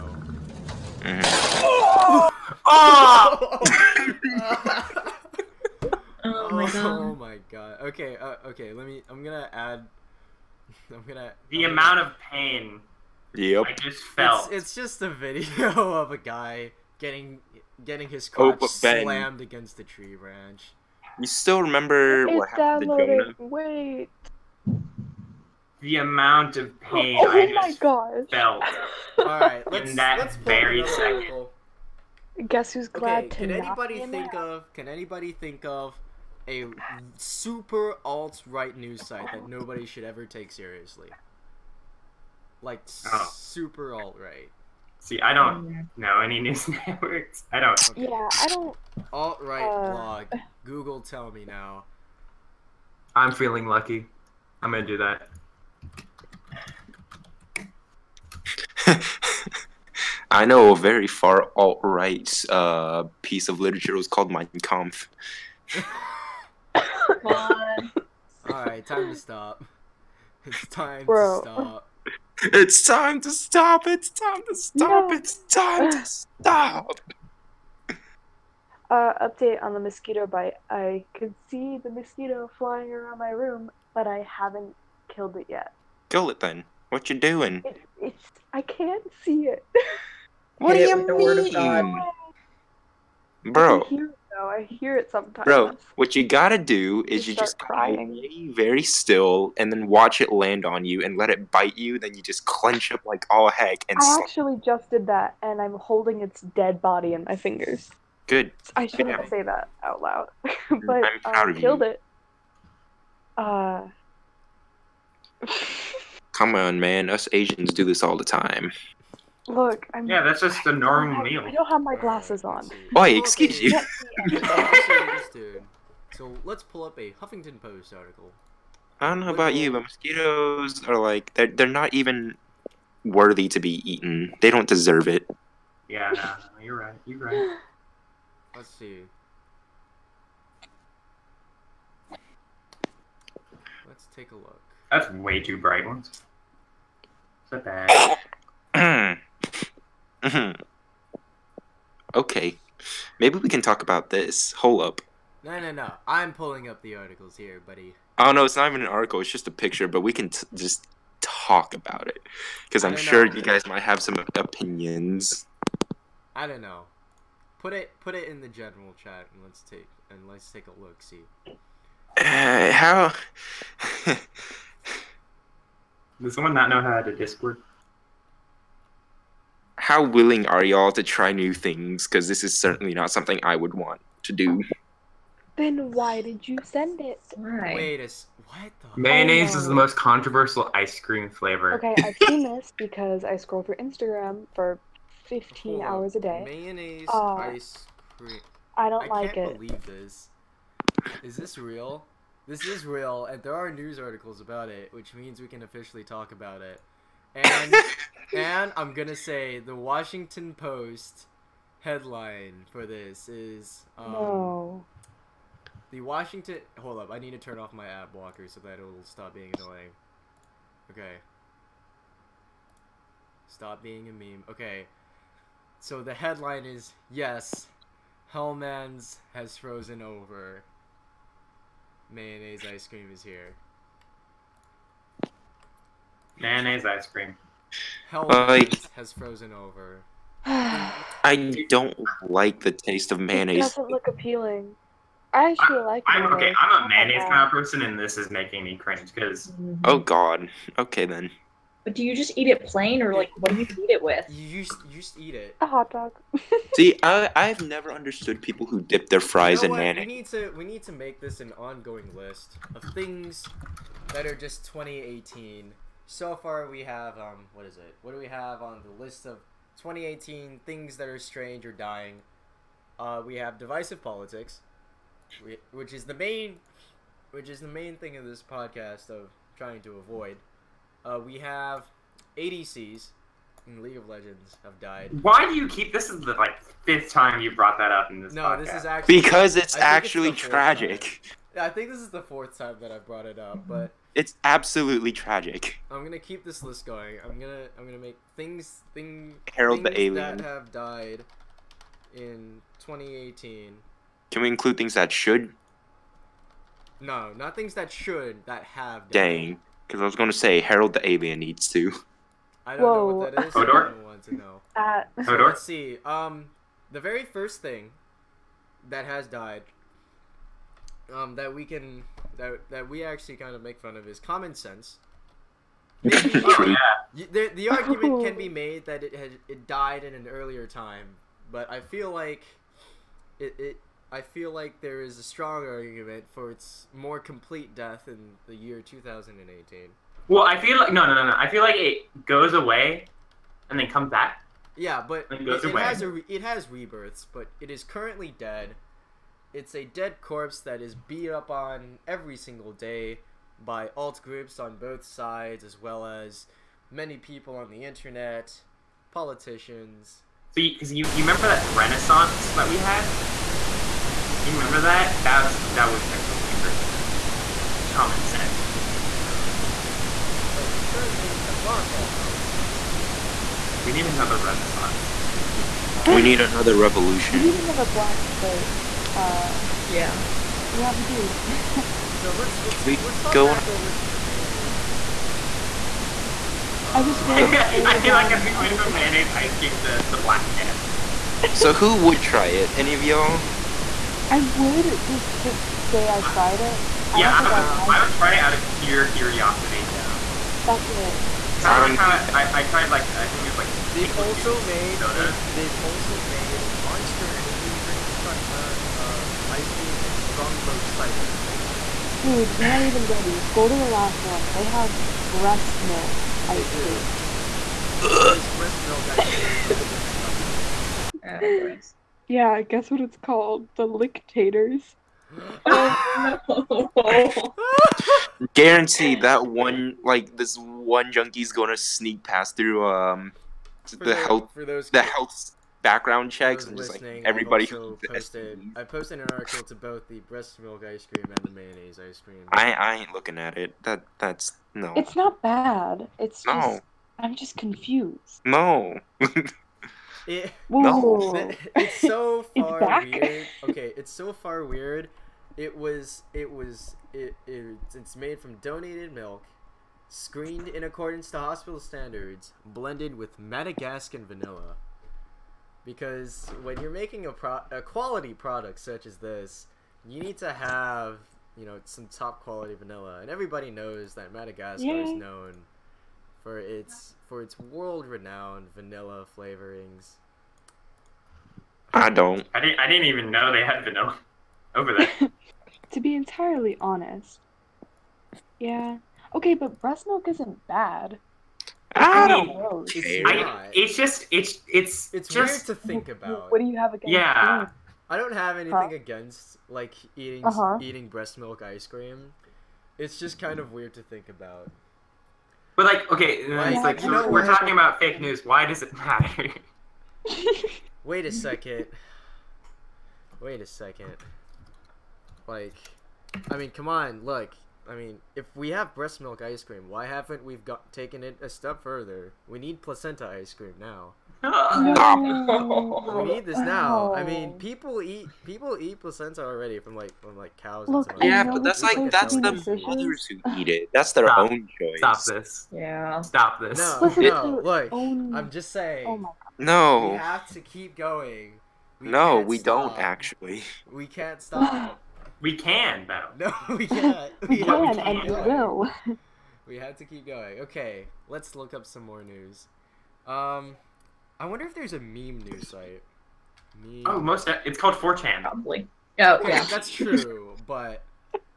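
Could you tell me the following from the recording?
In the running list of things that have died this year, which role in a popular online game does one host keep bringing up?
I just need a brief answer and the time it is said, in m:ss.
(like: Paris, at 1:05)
ADCs, at 4:42.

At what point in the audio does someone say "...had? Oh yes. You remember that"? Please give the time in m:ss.
6:02.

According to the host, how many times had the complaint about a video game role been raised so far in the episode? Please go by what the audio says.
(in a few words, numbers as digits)
4.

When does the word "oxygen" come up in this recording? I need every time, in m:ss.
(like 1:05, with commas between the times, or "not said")
not said.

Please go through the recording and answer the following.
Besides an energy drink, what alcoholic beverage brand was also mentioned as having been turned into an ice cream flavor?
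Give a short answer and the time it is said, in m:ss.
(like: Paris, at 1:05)
Strongbow cider, at 6:50.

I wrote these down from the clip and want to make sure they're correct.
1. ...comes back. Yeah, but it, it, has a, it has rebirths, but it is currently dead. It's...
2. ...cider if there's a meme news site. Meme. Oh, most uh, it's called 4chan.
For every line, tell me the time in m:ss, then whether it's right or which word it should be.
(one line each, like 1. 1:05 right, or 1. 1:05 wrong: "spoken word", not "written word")
1. 5:43 right
2. 9:14 wrong: "wonder", not "cider".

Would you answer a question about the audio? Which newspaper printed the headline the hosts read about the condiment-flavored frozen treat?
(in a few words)
Washington Post.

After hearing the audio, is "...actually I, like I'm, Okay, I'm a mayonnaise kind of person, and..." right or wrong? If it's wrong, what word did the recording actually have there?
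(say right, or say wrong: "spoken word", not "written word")
right.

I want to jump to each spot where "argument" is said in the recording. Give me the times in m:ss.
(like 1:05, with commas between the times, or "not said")
5:27, 5:35.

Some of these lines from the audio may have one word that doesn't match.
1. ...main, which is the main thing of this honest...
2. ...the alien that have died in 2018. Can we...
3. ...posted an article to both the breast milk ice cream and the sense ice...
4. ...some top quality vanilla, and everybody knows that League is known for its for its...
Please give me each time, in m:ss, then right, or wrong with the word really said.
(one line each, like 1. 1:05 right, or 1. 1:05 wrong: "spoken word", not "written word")
1. 4:36 wrong: "podcast", not "honest"
2. 4:59 right
3. 7:18 wrong: "mayonnaise", not "sense"
4. 7:51 wrong: "Madagascar", not "League".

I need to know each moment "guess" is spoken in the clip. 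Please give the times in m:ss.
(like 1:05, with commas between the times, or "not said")
0:32, 7:02.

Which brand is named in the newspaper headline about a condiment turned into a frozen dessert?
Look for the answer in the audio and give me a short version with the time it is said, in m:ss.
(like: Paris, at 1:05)
Hellmann's, at 3:48.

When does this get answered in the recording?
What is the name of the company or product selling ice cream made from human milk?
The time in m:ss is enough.
7:03.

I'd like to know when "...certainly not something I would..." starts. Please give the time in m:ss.
3:02.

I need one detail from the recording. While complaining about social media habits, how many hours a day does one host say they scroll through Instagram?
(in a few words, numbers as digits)
15.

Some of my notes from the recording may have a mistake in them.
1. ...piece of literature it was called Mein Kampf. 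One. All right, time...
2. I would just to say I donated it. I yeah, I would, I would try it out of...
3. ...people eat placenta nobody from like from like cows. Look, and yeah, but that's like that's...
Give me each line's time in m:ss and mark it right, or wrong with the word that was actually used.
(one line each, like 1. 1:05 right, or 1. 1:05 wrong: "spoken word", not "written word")
1. 1:03 right
2. 6:34 wrong: "tried", not "donated"
3. 8:48 wrong: "already", not "nobody".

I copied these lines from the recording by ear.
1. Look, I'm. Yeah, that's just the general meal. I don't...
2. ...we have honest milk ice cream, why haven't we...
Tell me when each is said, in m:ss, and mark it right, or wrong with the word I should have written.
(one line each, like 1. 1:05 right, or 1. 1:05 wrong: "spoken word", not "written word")
1. 1:59 wrong: "normal", not "general"
2. 8:38 wrong: "breast", not "honest".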